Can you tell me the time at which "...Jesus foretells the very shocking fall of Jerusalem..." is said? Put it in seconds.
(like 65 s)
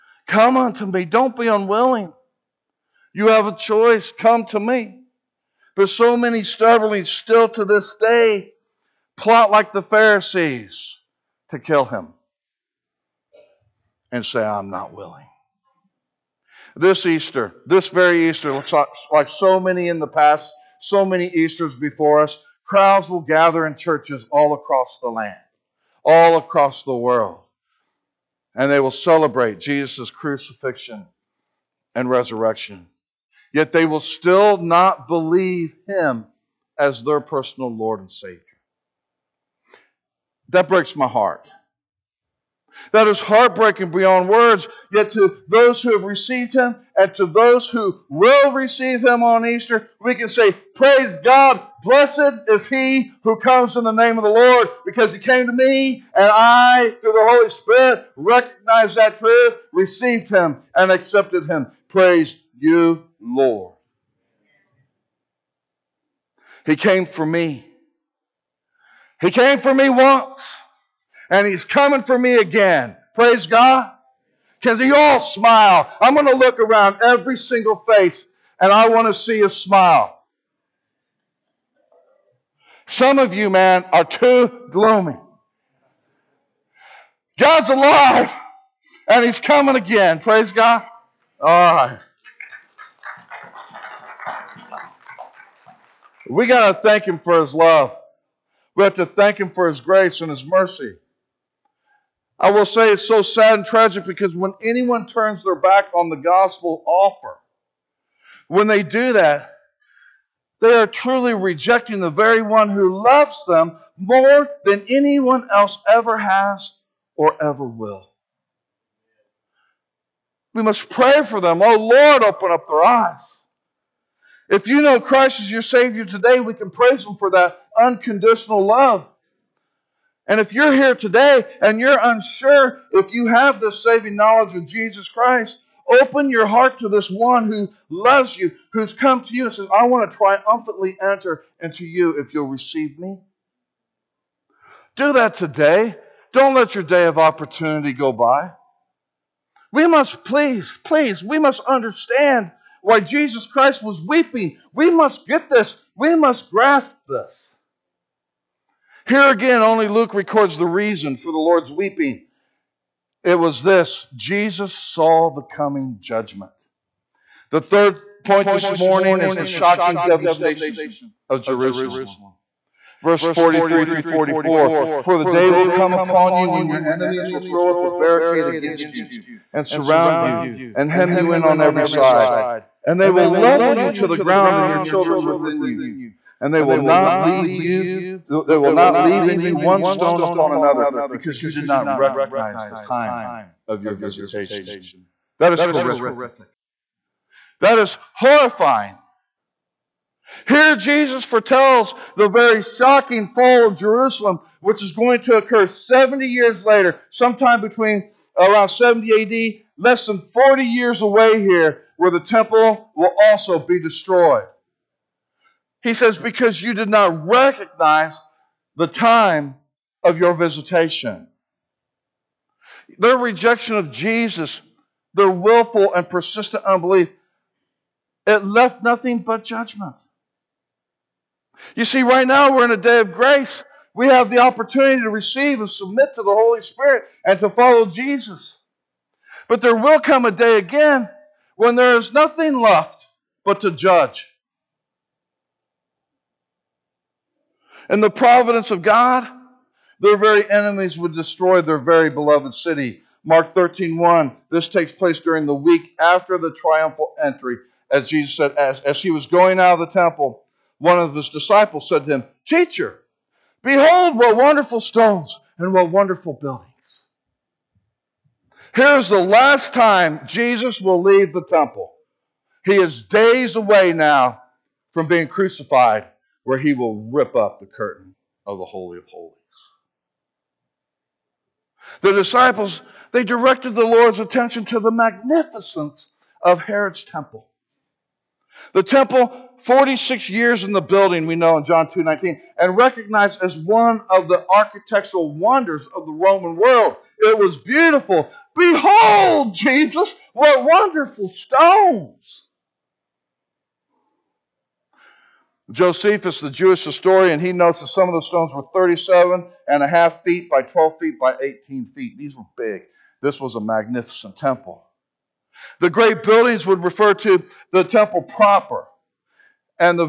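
200 s.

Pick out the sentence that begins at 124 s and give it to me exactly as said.
If you know Christ is your Savior today, we can praise Him for that unconditional love.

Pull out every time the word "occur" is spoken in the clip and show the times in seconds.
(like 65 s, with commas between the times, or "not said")
205 s.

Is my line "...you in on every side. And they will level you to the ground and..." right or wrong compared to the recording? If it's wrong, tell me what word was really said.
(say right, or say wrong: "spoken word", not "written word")
right.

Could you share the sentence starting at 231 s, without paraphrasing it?
You see, right now we're in a day of grace.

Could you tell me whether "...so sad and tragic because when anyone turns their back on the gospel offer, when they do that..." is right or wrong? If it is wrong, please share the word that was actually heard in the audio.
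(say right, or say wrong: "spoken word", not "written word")
right.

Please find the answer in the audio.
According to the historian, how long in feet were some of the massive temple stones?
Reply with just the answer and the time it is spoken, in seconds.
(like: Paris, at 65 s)
37.5 feet, at 308 s.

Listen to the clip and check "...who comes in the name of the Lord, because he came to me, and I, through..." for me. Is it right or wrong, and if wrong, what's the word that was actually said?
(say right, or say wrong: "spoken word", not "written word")
right.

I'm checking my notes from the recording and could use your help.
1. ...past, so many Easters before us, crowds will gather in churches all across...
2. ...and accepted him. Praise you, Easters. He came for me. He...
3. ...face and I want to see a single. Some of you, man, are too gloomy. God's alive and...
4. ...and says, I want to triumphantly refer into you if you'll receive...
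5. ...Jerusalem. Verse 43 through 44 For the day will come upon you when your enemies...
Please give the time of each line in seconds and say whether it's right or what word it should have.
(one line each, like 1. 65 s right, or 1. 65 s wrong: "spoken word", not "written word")
1. 20 s right
2. 60 s wrong: "Lord", not "Easters"
3. 77 s wrong: "smile", not "single"
4. 139 s wrong: "enter", not "refer"
5. 171 s right.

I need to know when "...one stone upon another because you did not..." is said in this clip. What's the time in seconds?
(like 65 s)
189 s.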